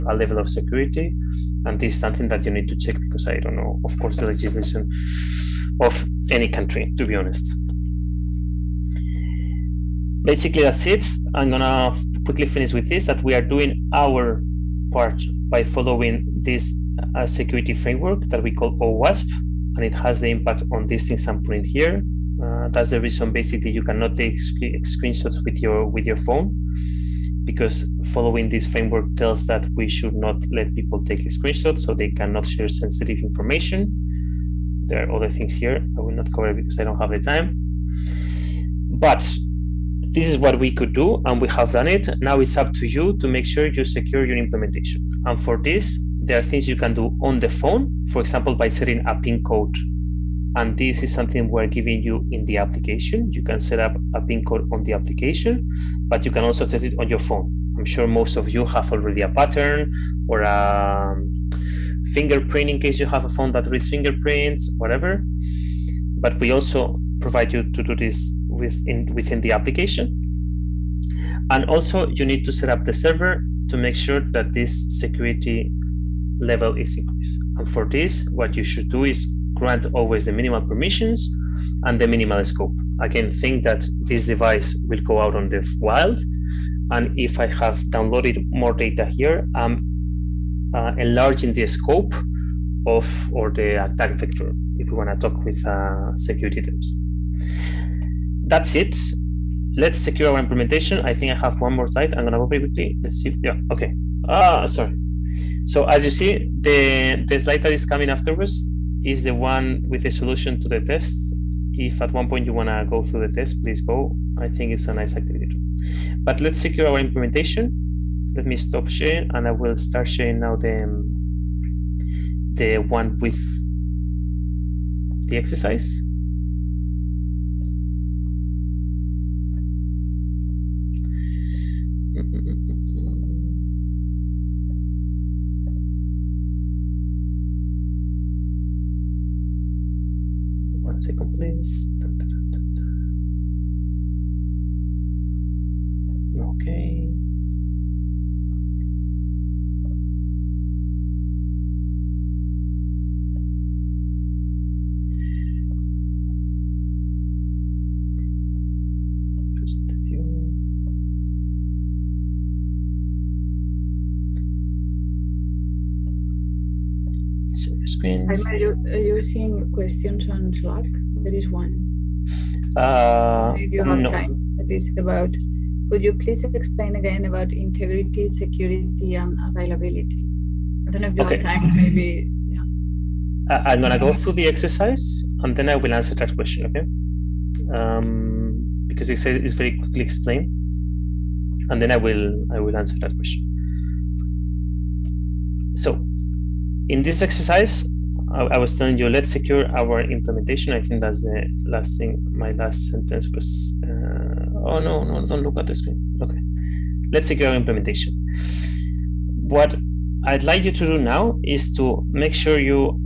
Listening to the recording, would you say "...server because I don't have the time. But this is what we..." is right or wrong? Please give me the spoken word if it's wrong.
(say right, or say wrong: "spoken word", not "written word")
wrong: "cover", not "server".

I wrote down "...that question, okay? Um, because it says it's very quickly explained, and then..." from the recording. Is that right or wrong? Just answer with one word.
right.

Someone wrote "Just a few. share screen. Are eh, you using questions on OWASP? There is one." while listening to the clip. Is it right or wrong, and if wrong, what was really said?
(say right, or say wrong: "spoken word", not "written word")
wrong: "Slack", not "OWASP".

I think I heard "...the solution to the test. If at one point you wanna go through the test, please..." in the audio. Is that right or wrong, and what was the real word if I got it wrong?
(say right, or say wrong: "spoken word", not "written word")
right.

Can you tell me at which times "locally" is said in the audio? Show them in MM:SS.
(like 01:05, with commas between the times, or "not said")
not said.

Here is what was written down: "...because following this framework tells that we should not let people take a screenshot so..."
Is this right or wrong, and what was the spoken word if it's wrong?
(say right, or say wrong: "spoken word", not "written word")
right.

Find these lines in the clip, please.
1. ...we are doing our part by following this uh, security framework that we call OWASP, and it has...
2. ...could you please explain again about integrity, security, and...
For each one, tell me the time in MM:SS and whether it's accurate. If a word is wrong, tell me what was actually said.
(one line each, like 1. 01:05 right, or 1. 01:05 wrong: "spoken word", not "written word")
1. 00:13 right
2. 02:55 right.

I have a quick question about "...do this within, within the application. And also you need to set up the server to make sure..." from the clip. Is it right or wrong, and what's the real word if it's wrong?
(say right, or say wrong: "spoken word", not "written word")
right.